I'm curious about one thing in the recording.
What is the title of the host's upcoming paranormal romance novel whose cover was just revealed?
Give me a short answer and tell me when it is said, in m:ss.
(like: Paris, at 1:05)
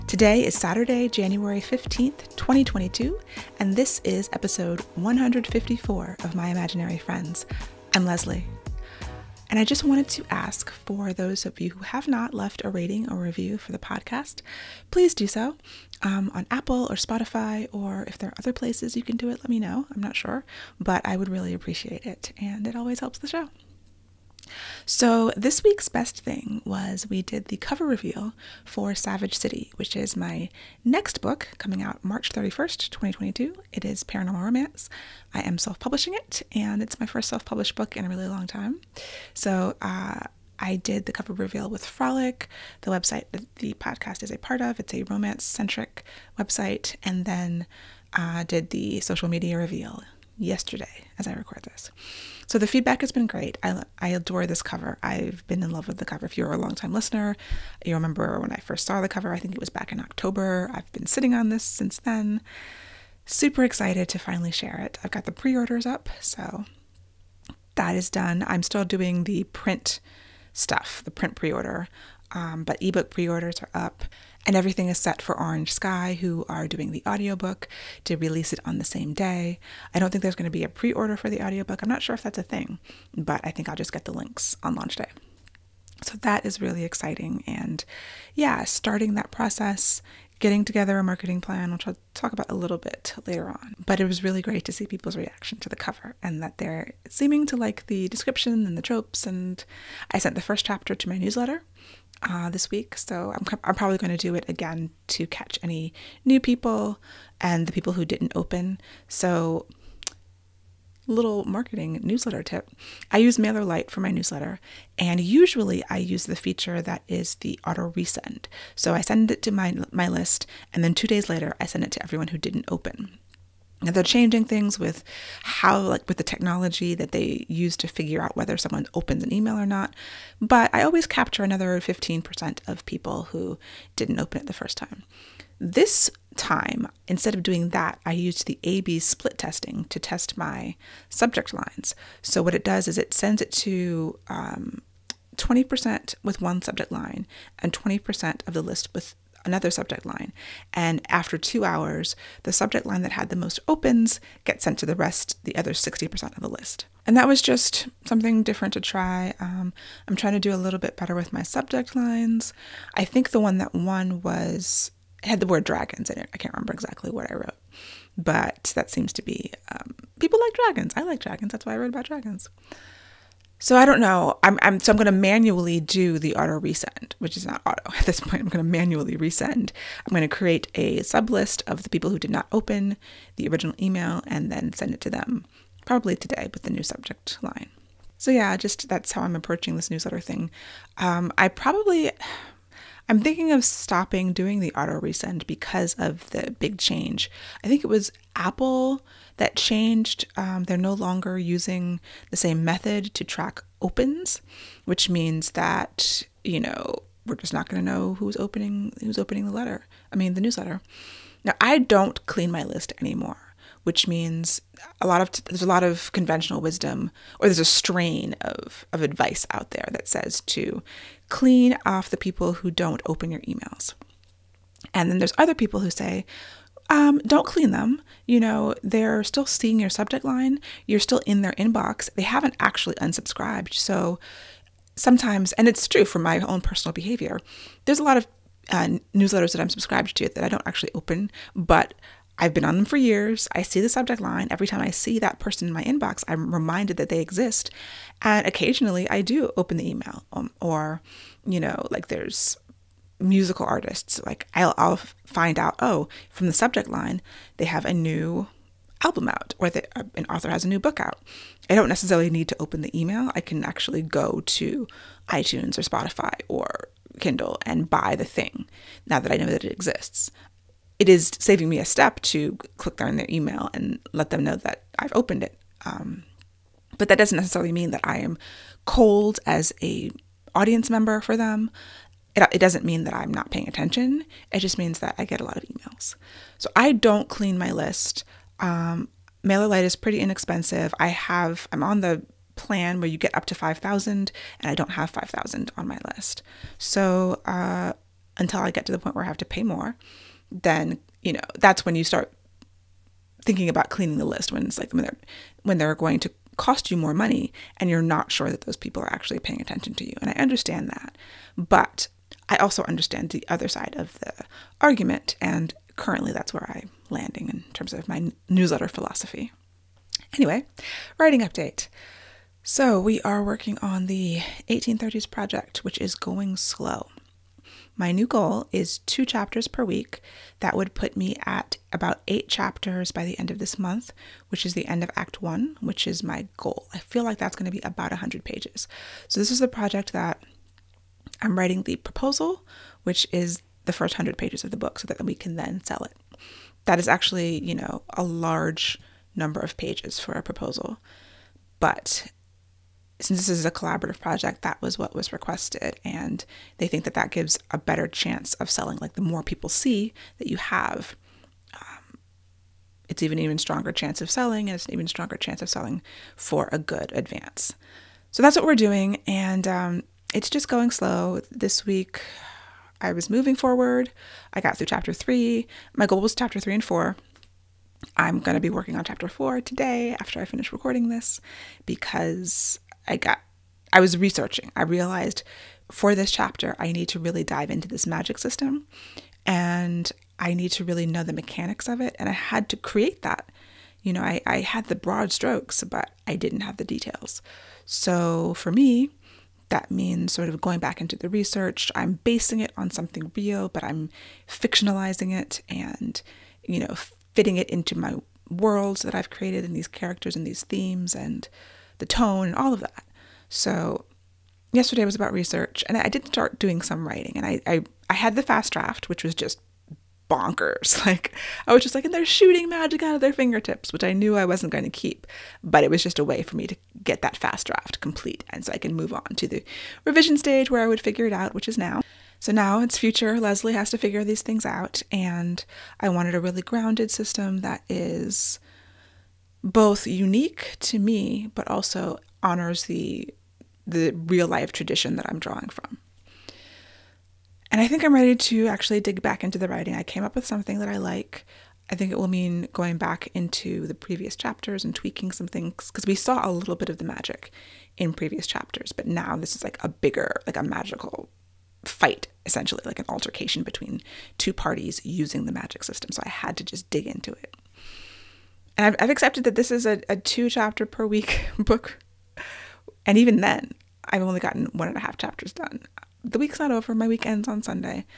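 Savage City, at 0:28.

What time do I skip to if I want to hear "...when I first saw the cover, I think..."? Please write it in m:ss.
0:58.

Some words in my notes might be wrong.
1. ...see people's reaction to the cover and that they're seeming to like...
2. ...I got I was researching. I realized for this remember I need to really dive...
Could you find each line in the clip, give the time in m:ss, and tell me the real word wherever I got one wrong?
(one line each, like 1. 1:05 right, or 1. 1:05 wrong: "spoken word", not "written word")
1. 1:34 right
2. 6:23 wrong: "chapter", not "remember".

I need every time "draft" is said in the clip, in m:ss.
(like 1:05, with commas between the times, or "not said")
6:58, 7:07.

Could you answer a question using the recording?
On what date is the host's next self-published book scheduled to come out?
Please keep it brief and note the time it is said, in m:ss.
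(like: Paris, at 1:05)
March 31st, 2022, at 0:32.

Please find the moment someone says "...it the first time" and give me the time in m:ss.
2:14.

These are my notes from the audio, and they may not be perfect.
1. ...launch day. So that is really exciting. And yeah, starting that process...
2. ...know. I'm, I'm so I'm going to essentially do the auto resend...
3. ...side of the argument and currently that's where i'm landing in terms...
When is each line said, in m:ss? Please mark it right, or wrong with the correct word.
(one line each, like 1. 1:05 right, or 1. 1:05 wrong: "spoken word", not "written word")
1. 1:24 right
2. 2:54 wrong: "manually", not "essentially"
3. 5:13 right.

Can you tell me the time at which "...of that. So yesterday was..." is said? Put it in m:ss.
6:52.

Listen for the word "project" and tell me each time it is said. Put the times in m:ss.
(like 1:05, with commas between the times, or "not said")
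5:25, 5:39, 5:54.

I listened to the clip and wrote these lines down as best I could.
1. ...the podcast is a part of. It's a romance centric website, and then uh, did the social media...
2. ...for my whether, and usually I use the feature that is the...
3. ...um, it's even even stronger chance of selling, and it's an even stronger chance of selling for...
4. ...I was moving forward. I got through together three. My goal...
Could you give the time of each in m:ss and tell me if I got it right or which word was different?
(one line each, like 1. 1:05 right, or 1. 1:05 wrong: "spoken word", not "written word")
1. 0:43 right
2. 1:53 wrong: "newsletter", not "whether"
3. 6:01 right
4. 6:13 wrong: "chapter", not "together".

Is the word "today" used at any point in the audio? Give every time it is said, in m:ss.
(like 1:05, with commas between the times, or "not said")
0:00, 3:06, 6:19.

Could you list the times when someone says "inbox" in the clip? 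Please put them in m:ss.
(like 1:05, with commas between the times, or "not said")
3:51, 4:05.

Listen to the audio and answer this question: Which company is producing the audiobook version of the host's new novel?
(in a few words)
Orange Sky.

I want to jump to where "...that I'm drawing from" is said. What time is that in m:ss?
7:25.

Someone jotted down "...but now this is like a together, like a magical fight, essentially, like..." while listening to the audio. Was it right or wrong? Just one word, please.
wrong.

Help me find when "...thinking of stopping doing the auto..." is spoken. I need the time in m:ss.
3:13.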